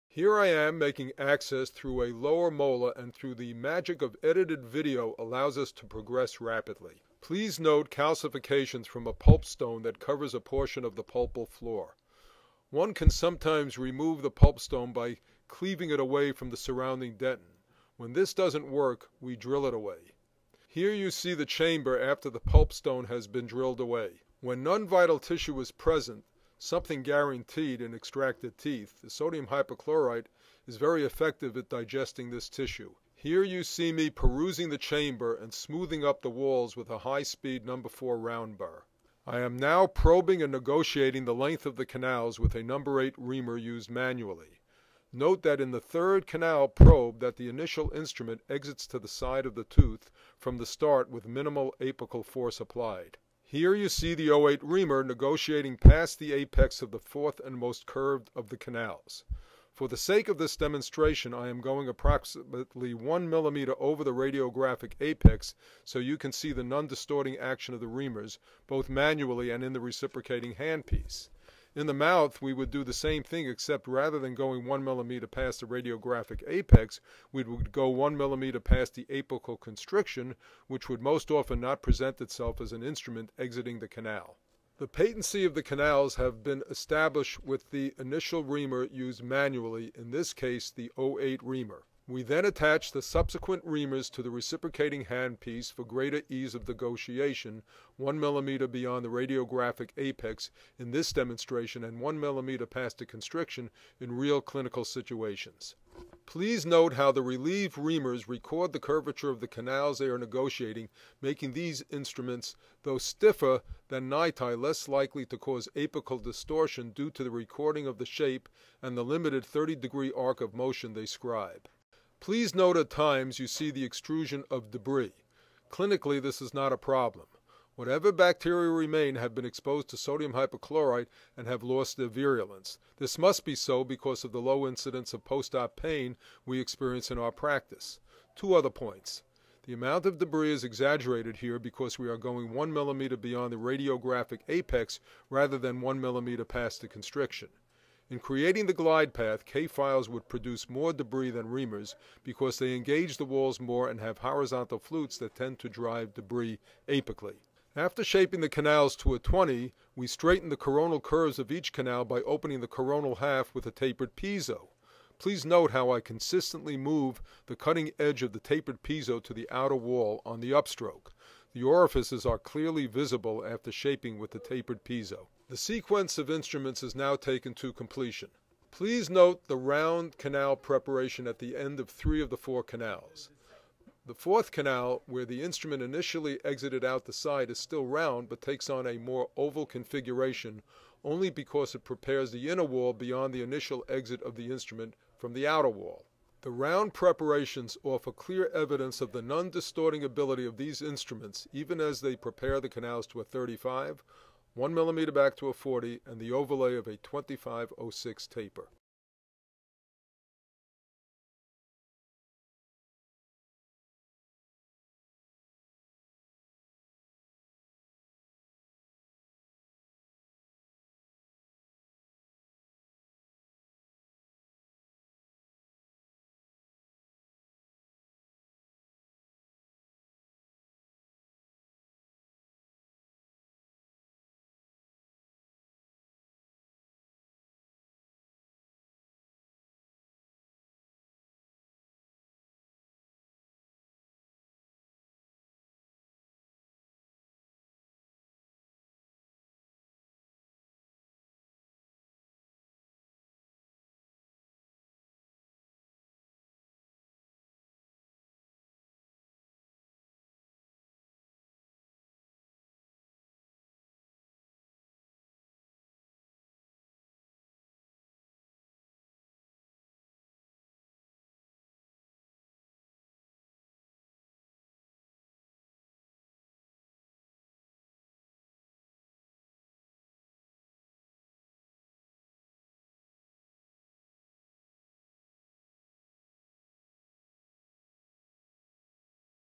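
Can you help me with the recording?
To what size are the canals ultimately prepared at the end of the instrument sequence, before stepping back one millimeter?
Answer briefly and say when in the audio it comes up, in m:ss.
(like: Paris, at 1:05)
35, at 3:23.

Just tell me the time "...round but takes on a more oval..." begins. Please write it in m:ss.
3:07.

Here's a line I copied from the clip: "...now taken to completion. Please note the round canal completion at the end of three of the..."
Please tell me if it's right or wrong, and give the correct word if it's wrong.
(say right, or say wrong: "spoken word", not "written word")
wrong: "preparation", not "completion".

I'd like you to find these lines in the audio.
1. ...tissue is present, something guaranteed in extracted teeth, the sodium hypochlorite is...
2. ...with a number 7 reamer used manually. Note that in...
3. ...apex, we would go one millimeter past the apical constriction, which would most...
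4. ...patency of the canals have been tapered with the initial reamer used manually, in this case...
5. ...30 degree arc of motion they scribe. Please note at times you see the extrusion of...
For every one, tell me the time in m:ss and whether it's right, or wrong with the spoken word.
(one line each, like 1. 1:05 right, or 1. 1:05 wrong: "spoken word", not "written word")
1. 0:25 right
2. 0:42 wrong: "8", not "7"
3. 1:16 right
4. 1:24 wrong: "established", not "tapered"
5. 1:59 right.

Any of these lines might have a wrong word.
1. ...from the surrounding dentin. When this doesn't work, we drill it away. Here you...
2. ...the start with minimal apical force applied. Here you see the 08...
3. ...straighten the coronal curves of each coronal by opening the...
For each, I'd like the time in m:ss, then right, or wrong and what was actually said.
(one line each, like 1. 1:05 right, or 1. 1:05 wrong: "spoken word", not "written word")
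1. 0:16 right
2. 0:50 right
3. 2:40 wrong: "canal", not "coronal".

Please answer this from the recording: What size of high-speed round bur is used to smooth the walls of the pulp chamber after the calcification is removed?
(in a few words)
number 4.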